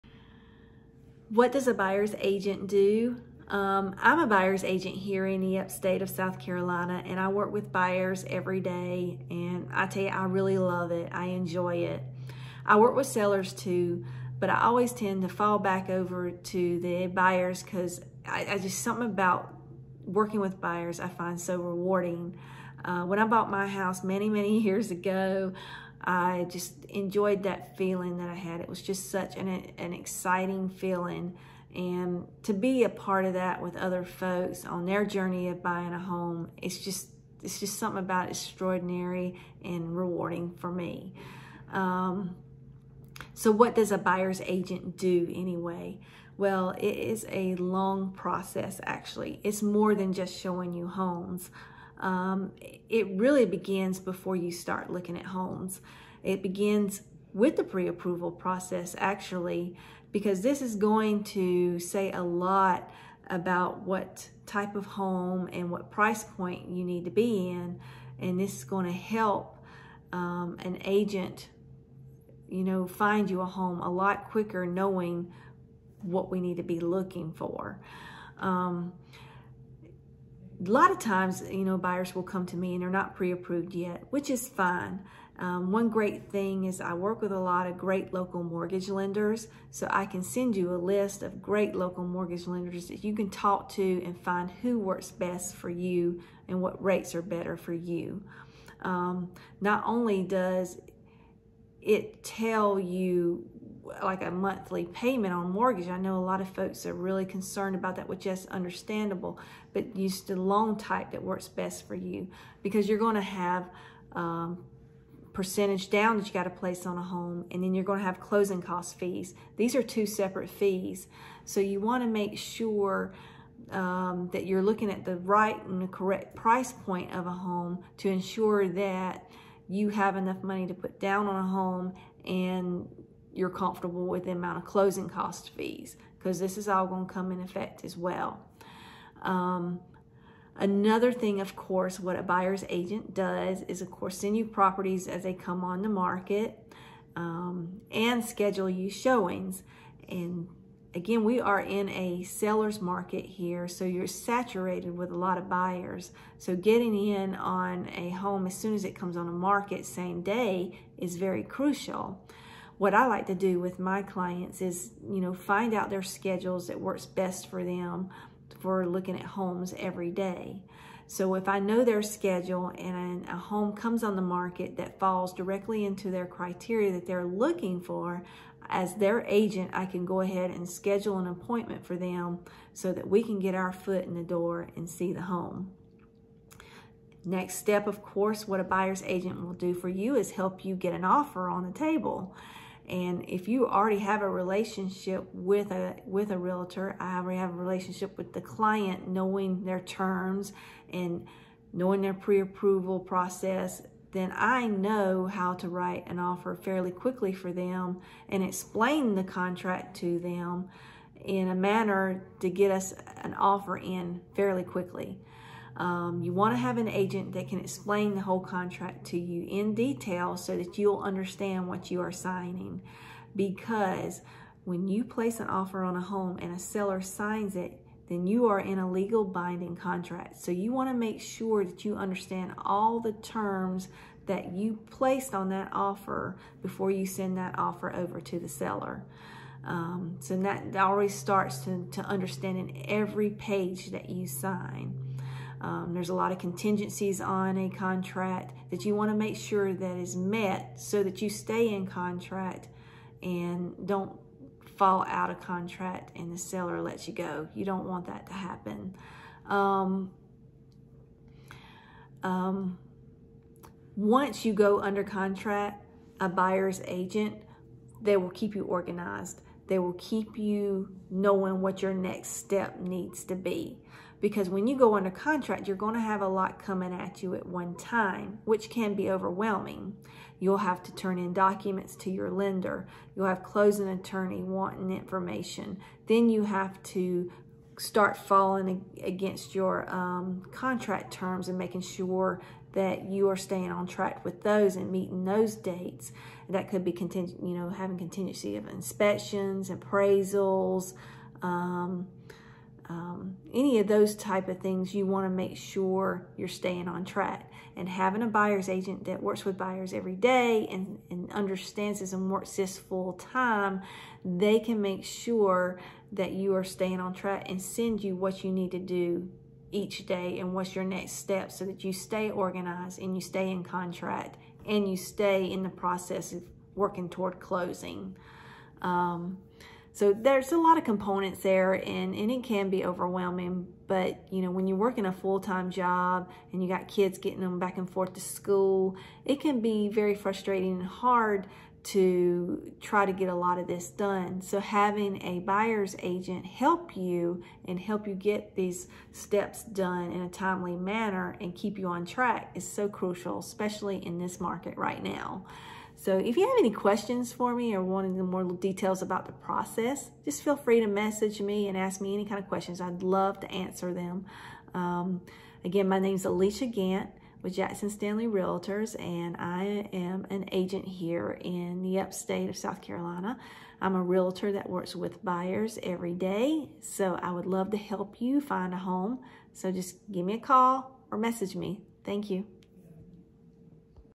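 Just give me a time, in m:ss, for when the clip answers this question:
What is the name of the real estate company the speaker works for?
6:07.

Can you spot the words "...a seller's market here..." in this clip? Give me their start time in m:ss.
2:31.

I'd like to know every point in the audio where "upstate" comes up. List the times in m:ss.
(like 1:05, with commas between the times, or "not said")
0:05, 6:11.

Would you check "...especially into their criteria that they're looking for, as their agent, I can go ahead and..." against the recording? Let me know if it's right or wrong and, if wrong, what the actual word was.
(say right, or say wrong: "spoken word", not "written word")
wrong: "directly", not "especially".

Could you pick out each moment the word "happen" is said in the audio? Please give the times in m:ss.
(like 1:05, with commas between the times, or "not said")
4:18.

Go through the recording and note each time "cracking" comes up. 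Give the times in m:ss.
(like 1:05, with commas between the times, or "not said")
not said.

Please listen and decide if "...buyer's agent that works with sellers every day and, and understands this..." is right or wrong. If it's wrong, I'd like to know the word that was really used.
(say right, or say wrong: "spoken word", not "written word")
wrong: "buyers", not "sellers".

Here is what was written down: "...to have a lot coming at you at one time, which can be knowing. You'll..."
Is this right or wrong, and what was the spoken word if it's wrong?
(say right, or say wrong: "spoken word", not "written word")
wrong: "overwhelming", not "knowing".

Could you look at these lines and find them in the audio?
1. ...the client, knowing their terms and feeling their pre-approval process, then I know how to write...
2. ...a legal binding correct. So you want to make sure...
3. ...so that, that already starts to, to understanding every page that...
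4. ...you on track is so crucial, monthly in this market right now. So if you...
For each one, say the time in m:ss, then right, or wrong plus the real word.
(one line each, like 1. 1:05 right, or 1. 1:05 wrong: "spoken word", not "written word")
1. 3:18 wrong: "knowing", not "feeling"
2. 3:48 wrong: "contract", not "correct"
3. 4:00 right
4. 5:51 wrong: "especially", not "monthly".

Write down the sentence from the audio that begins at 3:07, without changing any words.
Next step, of course, what a buyer's agent will do for you is help you get an offer on the table.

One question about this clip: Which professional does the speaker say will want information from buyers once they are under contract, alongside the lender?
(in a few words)
Closing attorney.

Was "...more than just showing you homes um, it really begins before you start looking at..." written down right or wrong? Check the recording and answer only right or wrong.
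right.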